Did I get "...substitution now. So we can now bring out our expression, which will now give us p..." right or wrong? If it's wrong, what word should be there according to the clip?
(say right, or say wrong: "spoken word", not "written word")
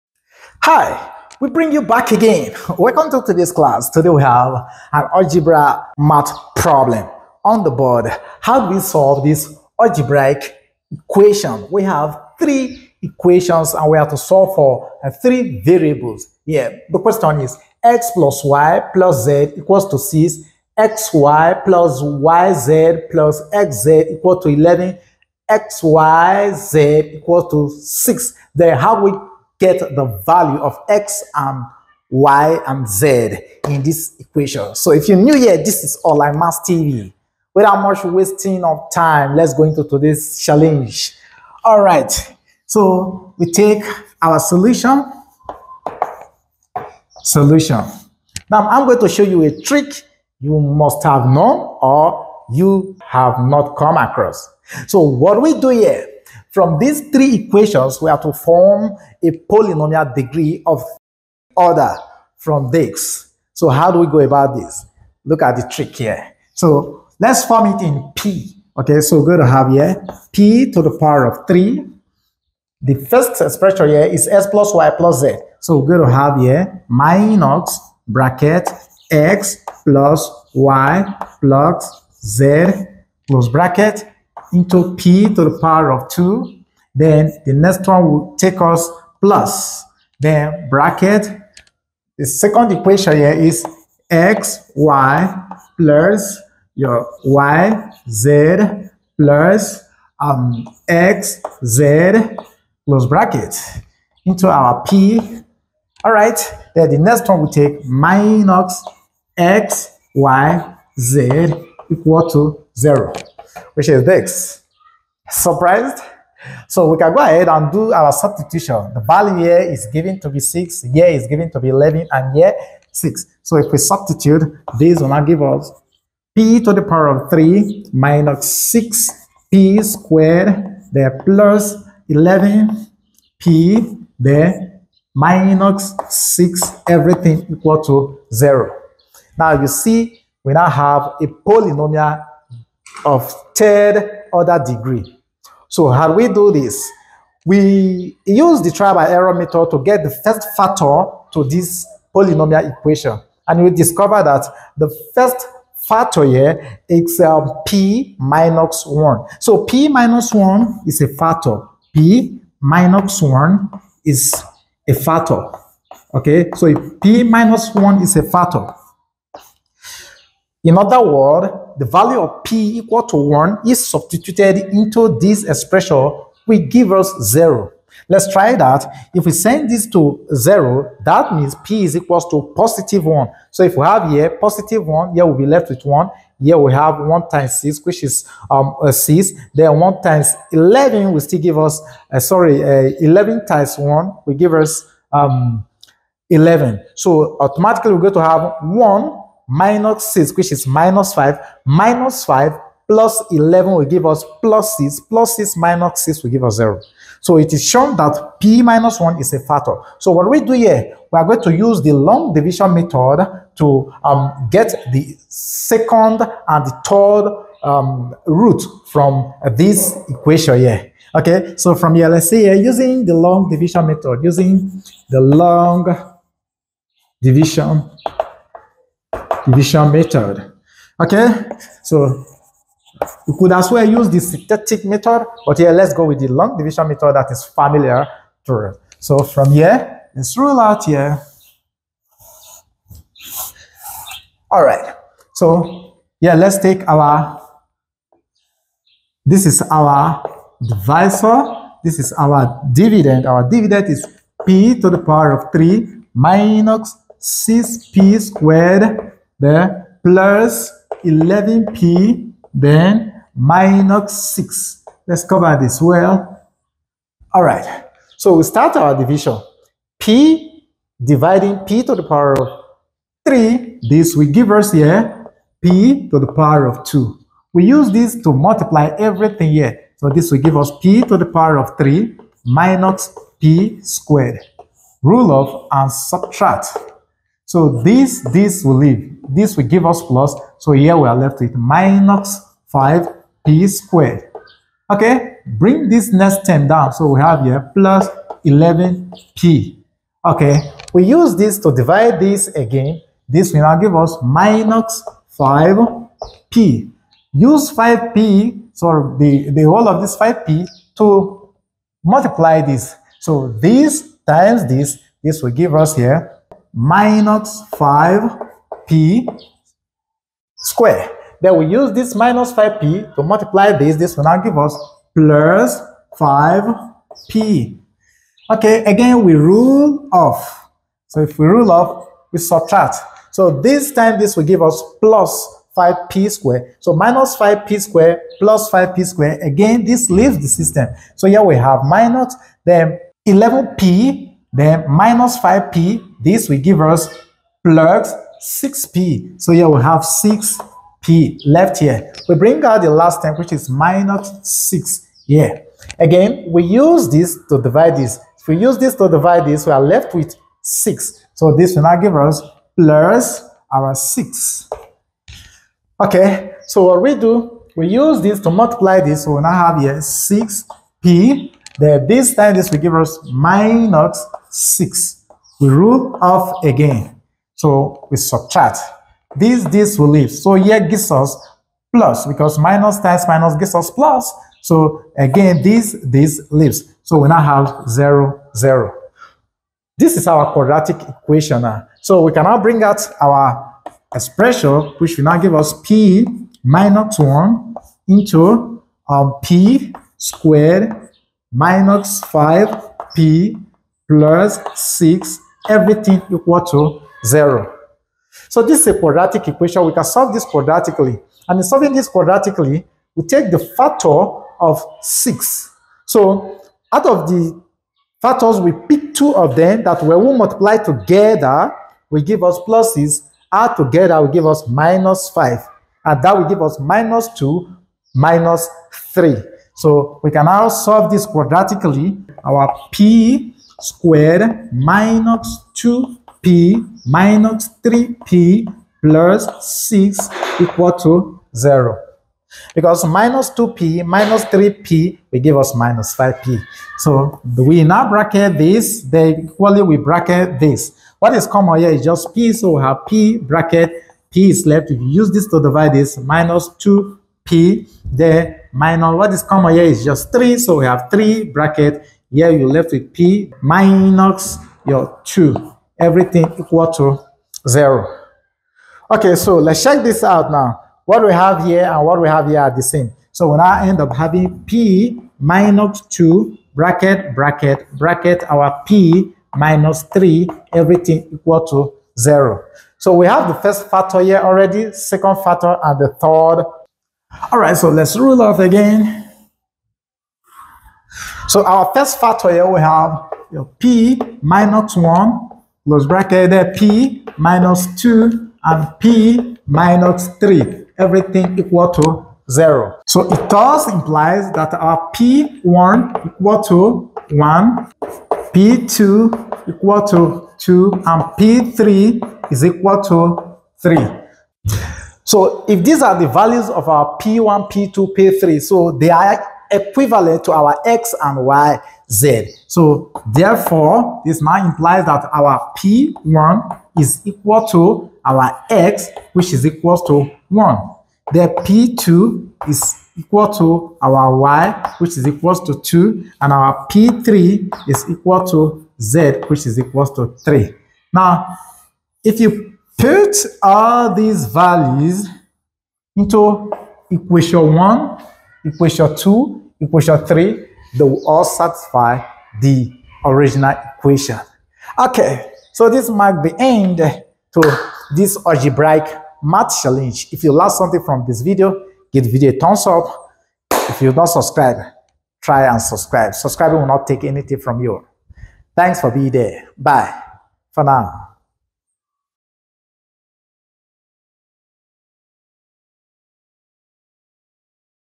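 wrong: "equation", not "substitution".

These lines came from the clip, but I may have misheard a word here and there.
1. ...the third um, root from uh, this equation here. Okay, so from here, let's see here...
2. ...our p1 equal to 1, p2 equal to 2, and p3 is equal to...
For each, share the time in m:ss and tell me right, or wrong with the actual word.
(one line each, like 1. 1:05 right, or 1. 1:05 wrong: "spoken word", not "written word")
1. 3:36 right
2. 8:24 right.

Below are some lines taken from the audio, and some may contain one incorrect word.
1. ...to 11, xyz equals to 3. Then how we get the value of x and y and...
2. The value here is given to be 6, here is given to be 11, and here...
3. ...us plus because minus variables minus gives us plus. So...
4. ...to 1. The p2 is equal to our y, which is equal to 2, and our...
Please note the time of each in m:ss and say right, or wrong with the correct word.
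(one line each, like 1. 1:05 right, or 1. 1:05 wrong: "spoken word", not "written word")
1. 0:24 wrong: "6", not "3"
2. 1:58 right
3. 6:21 wrong: "times", not "variables"
4. 8:50 right.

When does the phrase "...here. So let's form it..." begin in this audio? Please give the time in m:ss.
1:05.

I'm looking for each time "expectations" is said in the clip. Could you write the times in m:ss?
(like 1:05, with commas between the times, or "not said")
not said.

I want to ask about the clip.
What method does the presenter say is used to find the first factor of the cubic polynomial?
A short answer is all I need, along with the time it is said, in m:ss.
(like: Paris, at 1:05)
trial by error, at 2:28.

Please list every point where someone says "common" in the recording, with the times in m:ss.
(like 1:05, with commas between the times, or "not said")
7:31, 7:39.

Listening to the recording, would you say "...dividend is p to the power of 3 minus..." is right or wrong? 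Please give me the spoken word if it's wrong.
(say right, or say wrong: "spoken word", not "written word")
right.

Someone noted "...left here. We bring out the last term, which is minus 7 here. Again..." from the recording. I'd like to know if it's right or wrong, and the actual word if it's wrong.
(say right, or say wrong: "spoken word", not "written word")
wrong: "6", not "7".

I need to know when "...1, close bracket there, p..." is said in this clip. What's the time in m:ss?
8:14.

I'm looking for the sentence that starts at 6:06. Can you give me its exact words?
Okay, so what we do, we use this to multiply this.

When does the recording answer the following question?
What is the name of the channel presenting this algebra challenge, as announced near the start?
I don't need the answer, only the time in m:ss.
0:36.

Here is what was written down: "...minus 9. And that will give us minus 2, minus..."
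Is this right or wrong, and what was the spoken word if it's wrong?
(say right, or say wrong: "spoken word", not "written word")
wrong: "5", not "9".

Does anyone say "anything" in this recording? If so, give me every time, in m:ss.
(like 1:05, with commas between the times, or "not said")
9:27.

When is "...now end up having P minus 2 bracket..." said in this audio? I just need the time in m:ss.
7:53.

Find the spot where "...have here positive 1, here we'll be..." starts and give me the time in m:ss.
3:03.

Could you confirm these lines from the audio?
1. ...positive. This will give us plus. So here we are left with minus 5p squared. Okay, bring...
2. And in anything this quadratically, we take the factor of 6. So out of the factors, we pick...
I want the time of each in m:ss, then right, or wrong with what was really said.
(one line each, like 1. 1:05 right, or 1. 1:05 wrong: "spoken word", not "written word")
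1. 4:48 wrong: "leave", not "positive"
2. 6:51 wrong: "solving", not "anything".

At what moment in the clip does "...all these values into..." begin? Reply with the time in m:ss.
9:03.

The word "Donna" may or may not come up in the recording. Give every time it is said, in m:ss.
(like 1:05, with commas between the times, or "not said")
not said.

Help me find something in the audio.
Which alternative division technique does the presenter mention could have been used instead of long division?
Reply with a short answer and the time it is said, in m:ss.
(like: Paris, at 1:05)
synthetic method, at 3:54.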